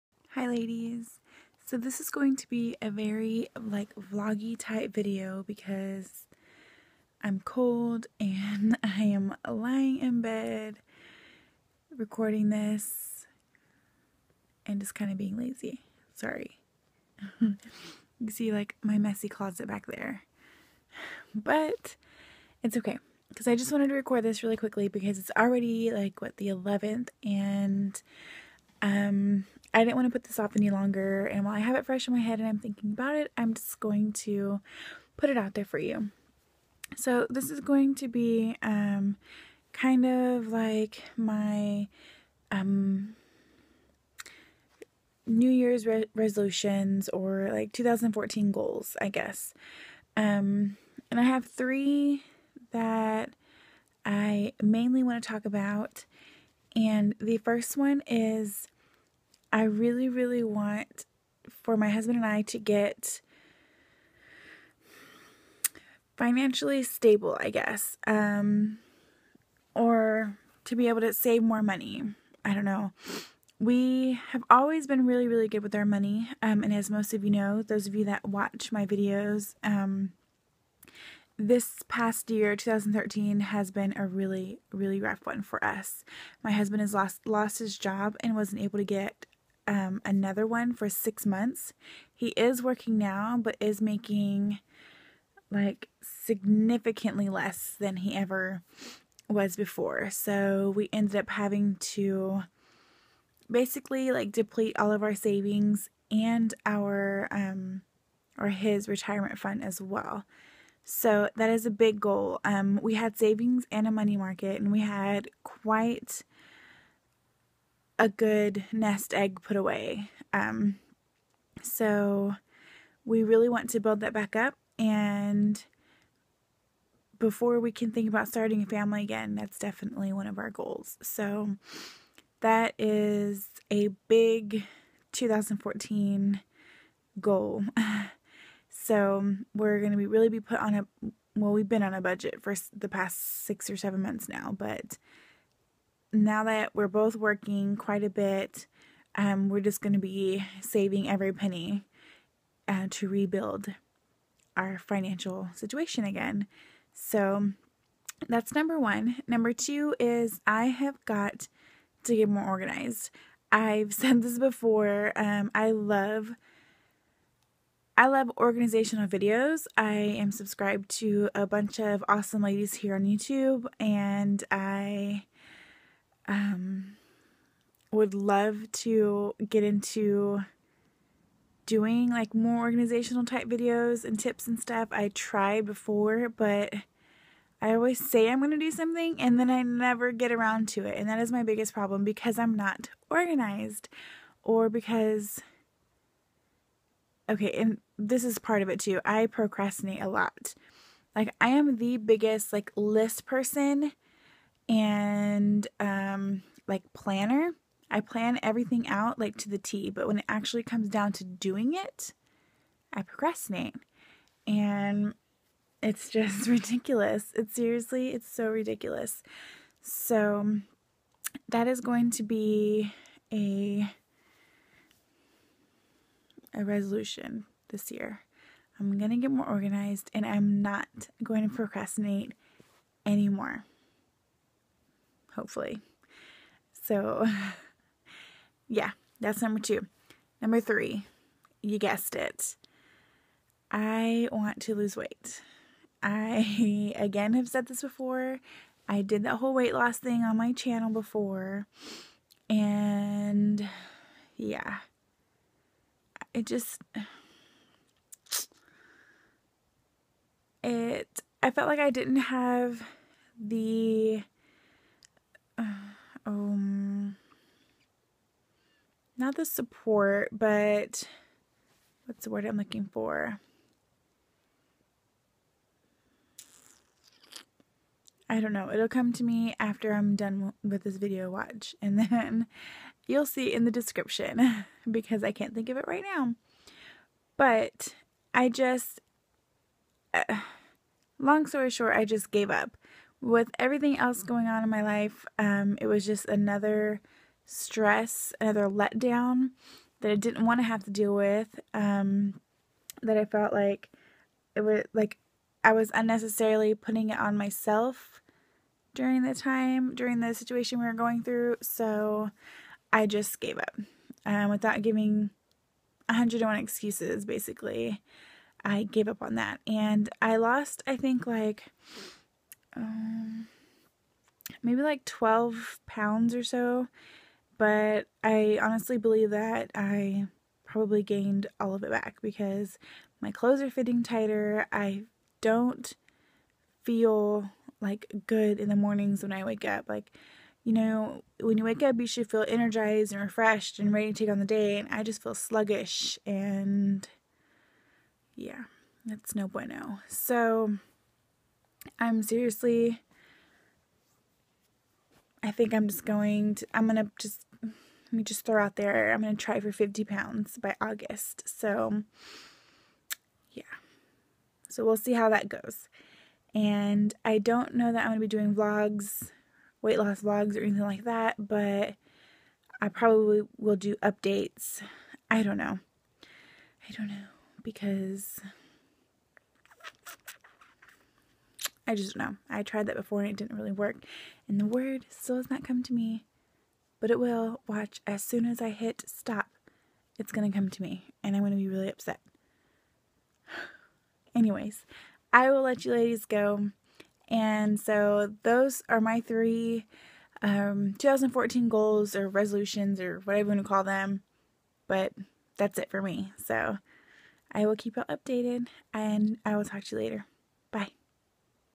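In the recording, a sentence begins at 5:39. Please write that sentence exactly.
Like, you know, when you wake up, you should feel energized and refreshed and ready to take on the day.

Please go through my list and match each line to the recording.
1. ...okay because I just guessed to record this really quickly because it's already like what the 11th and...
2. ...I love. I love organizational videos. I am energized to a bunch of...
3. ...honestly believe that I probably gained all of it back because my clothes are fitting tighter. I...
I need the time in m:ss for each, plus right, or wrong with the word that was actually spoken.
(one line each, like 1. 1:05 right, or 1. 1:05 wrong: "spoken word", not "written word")
1. 0:22 wrong: "wanted", not "guessed"
2. 2:45 wrong: "subscribed", not "energized"
3. 5:28 right.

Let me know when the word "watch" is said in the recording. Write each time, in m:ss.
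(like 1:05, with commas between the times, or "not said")
1:18, 4:41, 6:27.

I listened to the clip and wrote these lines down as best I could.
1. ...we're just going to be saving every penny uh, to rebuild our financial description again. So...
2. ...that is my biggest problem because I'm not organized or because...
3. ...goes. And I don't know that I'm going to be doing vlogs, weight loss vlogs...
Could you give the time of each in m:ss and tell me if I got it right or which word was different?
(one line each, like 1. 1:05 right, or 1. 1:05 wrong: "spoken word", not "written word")
1. 2:29 wrong: "situation", not "description"
2. 3:11 right
3. 6:05 right.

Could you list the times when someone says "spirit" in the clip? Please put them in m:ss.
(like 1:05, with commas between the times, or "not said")
not said.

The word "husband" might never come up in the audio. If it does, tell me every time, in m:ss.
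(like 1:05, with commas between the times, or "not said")
1:01, 1:26.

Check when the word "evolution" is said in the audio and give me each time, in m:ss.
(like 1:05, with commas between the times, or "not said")
not said.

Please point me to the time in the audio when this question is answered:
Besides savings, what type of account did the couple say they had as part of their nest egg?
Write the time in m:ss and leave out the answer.
1:53.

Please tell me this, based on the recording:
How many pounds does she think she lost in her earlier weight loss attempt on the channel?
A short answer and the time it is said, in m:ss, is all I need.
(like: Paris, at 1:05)
12 pounds, at 5:25.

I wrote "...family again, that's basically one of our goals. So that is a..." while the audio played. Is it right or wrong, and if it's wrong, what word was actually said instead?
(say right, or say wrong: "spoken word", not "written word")
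wrong: "definitely", not "basically".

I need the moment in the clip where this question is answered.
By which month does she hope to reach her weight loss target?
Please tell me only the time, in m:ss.
6:00.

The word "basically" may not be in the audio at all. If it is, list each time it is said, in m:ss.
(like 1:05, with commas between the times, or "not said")
1:43, 5:17.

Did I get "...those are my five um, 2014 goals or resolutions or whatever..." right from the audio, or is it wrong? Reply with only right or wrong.
wrong.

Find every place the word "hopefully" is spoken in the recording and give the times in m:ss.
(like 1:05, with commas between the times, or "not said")
3:55.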